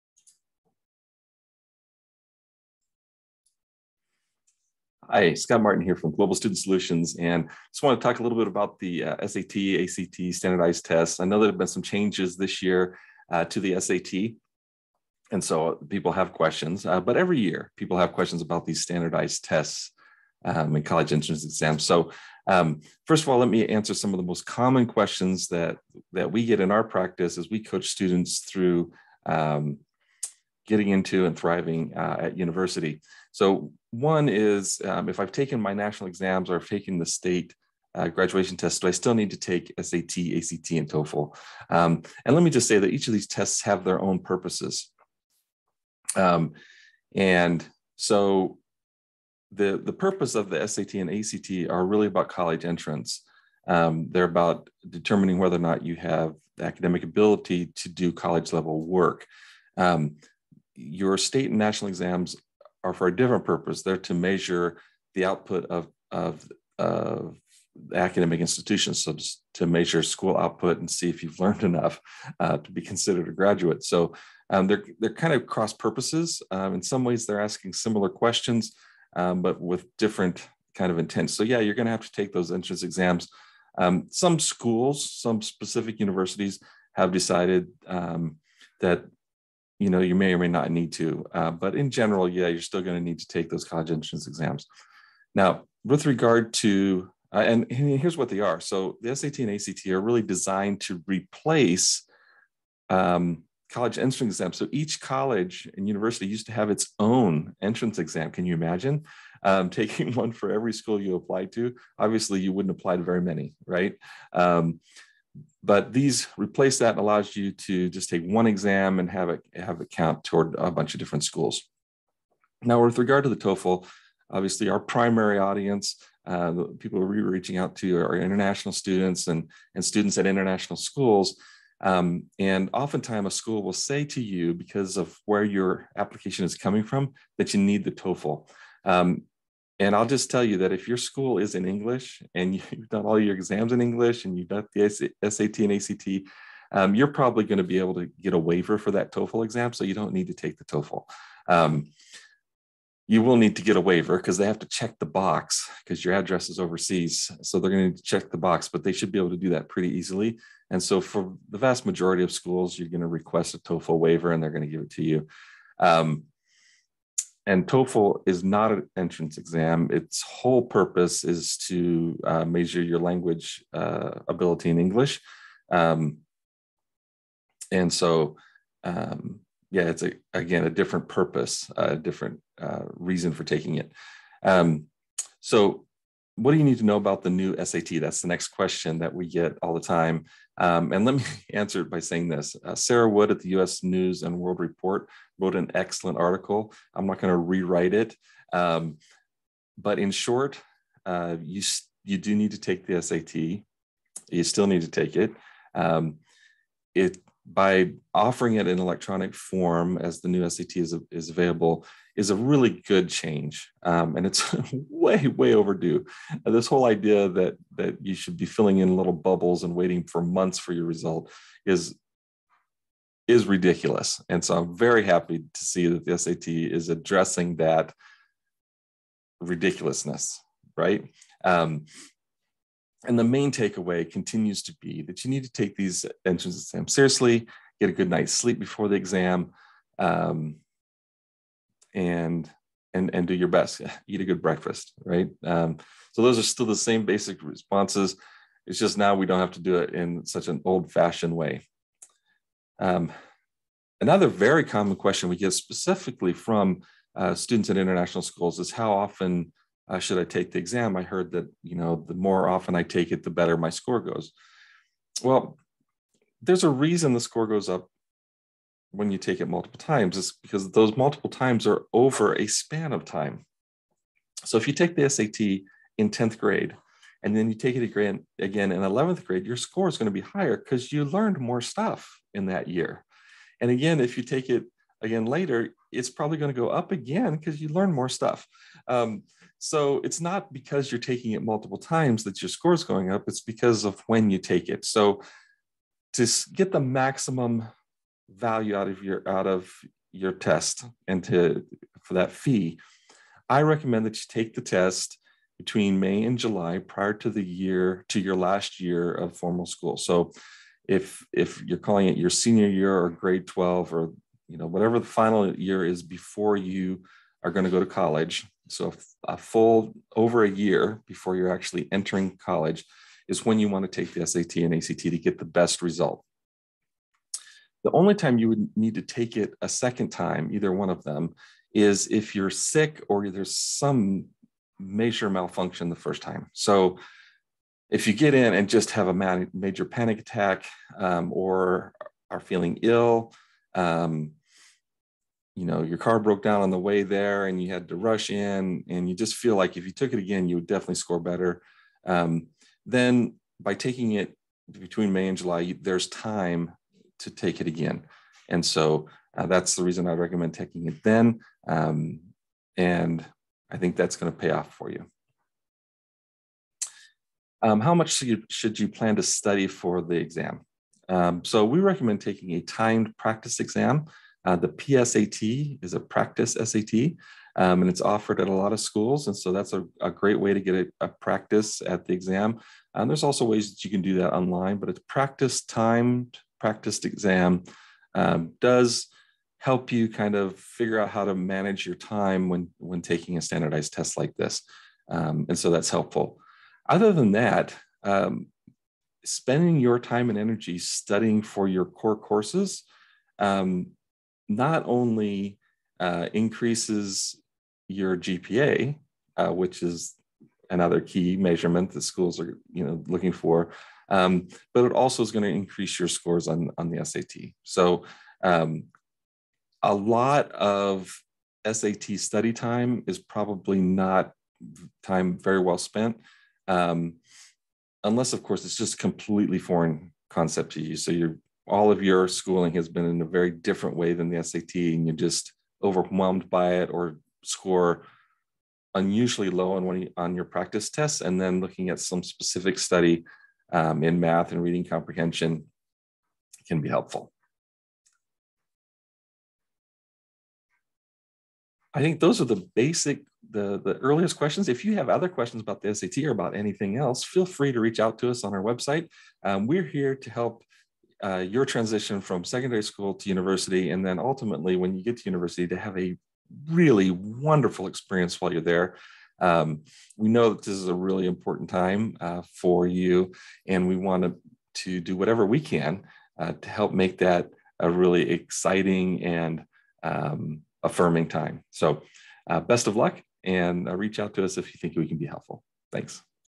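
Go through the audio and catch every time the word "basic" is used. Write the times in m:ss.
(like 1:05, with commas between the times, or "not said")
4:07, 7:32.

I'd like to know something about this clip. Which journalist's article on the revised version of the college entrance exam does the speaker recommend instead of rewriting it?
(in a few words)
Sarah Wood.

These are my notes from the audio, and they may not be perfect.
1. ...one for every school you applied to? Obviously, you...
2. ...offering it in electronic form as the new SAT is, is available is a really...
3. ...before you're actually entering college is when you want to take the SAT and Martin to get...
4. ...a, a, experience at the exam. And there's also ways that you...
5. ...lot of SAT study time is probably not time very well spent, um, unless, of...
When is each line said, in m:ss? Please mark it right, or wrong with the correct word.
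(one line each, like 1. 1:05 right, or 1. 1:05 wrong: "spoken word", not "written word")
1. 1:50 right
2. 3:28 right
3. 5:21 wrong: "ACT", not "Martin"
4. 6:20 wrong: "practice", not "experience"
5. 6:59 right.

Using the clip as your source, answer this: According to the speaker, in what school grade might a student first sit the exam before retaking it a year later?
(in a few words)
10th grade.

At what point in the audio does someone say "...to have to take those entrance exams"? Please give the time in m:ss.
1:21.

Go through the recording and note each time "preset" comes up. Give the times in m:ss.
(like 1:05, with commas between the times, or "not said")
not said.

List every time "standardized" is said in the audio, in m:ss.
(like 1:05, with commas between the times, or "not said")
0:10, 0:18, 6:33.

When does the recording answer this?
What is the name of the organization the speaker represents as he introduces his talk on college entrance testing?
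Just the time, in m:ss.
0:06.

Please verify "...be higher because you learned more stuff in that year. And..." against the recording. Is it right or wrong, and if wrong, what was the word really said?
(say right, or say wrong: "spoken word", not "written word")
right.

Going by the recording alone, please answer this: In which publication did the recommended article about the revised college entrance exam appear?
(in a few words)
US News and World Report.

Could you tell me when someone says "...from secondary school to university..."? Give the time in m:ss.
7:42.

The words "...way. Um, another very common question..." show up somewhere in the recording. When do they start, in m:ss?
4:11.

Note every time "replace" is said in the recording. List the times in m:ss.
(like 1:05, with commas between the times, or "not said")
1:41, 1:56.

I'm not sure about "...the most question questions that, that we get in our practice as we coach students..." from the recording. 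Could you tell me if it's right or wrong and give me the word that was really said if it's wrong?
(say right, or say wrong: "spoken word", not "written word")
wrong: "common", not "question".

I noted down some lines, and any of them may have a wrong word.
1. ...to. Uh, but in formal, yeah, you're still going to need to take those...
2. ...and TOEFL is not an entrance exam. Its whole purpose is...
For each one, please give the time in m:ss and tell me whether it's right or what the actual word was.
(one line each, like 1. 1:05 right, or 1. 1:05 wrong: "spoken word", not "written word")
1. 1:30 wrong: "general", not "formal"
2. 2:47 right.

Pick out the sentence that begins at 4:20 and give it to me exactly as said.
I heard that, you know, the more often I take it, the better my score goes.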